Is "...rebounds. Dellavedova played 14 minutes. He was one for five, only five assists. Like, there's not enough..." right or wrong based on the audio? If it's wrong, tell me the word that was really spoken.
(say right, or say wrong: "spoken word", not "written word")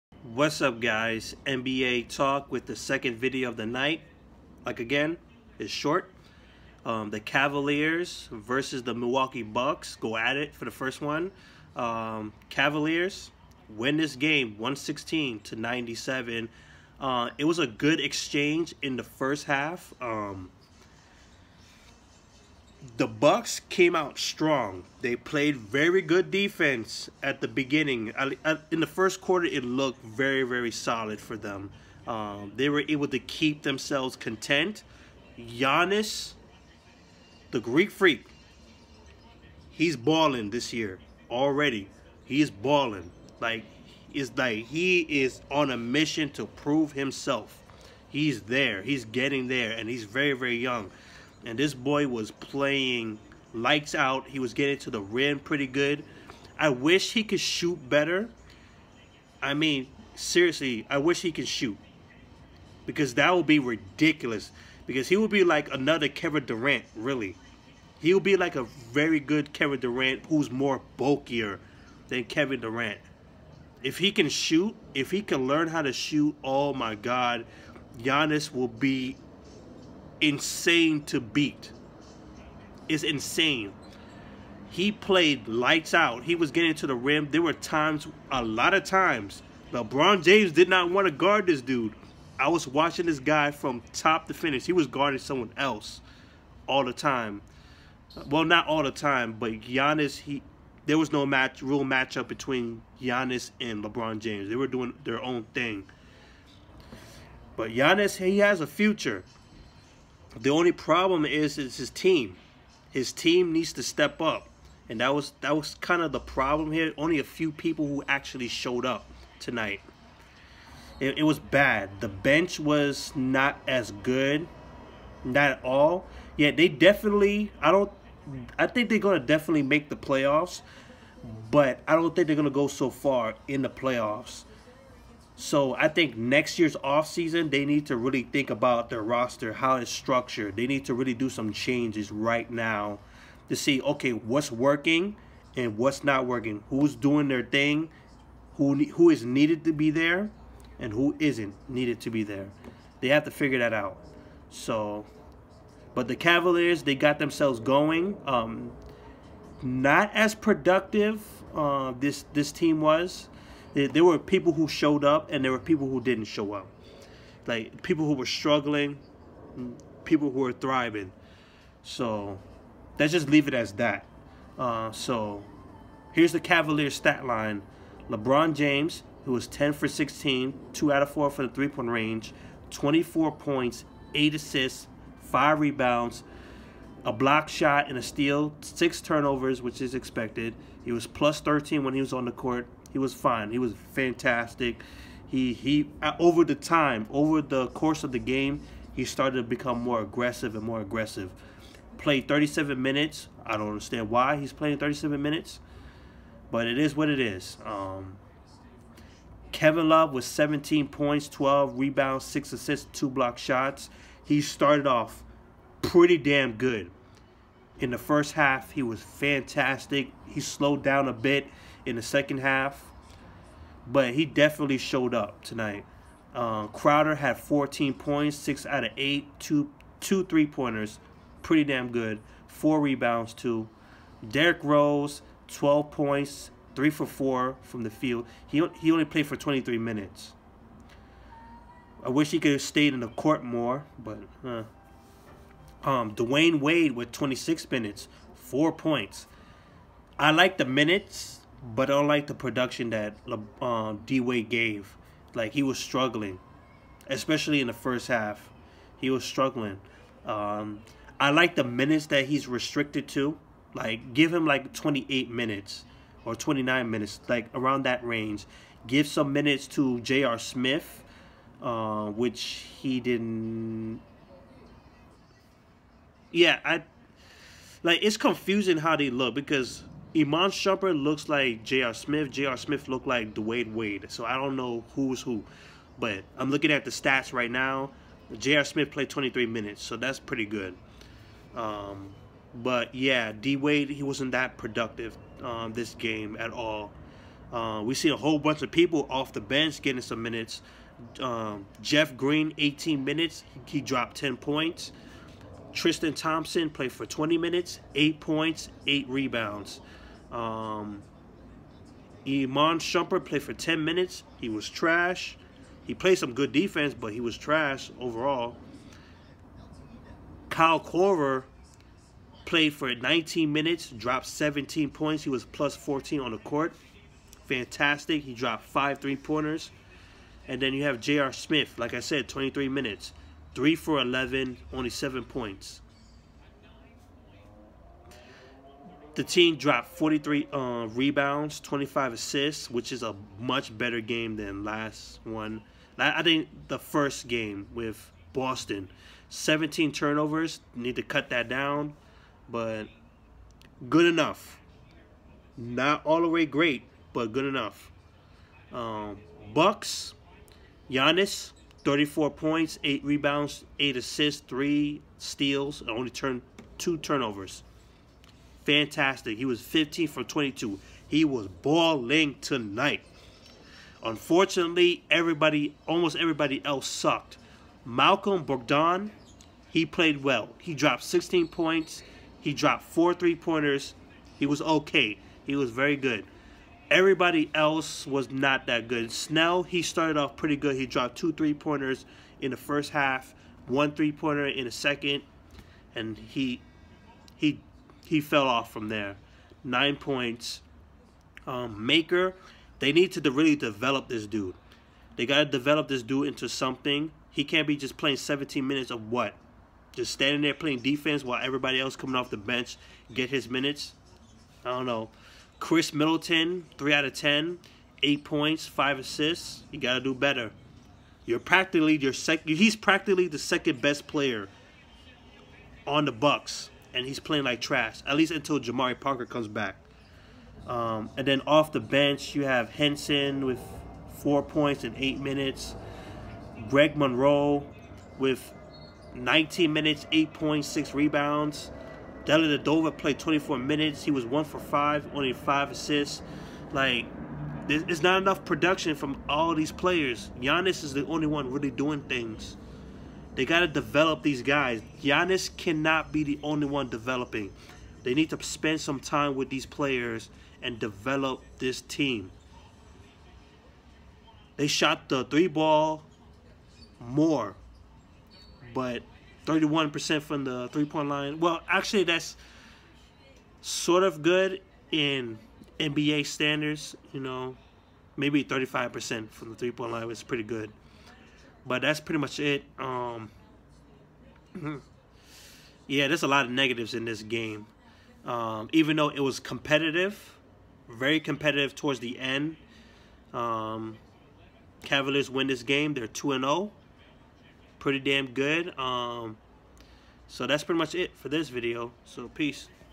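wrong: "24", not "14".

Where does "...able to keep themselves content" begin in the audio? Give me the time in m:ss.
0:32.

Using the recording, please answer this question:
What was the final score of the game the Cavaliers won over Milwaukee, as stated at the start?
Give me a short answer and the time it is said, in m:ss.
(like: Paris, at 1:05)
116 to 97, at 0:14.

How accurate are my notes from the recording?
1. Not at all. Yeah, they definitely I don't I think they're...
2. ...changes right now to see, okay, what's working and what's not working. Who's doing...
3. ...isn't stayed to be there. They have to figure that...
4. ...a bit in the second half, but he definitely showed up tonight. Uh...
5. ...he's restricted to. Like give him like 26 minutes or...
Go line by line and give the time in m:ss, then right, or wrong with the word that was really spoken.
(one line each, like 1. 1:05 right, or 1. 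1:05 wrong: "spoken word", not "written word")
1. 2:05 right
2. 2:21 right
3. 2:31 wrong: "needed", not "stayed"
4. 3:41 right
5. 4:22 wrong: "28", not "26".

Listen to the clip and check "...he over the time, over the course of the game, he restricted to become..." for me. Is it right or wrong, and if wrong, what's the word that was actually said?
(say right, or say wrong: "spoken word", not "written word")
wrong: "started", not "restricted".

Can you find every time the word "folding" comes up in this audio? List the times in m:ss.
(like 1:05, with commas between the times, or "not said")
not said.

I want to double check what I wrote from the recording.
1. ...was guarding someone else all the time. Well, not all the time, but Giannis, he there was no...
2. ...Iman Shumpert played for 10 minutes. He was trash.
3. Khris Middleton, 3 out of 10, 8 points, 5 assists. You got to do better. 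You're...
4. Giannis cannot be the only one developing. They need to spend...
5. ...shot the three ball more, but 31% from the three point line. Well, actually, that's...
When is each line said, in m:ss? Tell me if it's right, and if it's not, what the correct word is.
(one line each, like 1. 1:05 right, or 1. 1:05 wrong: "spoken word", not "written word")
1. 1:34 right
2. 5:12 right
3. 6:55 right
4. 7:35 right
5. 7:44 right.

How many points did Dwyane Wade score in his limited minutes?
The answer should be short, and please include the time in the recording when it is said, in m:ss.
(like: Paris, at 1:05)
4, at 4:08.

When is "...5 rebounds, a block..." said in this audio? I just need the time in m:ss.
3:05.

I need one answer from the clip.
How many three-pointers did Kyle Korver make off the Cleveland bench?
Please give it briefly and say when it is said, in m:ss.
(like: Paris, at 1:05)
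5, at 5:28.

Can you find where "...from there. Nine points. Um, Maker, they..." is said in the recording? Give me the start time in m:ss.
6:38.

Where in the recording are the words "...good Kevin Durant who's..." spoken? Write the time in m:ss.
1:09.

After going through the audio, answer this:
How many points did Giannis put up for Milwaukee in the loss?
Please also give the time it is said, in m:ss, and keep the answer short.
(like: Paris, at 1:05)
34, at 6:01.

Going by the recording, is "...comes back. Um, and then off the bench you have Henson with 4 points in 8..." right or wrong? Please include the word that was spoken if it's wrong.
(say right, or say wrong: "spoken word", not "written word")
right.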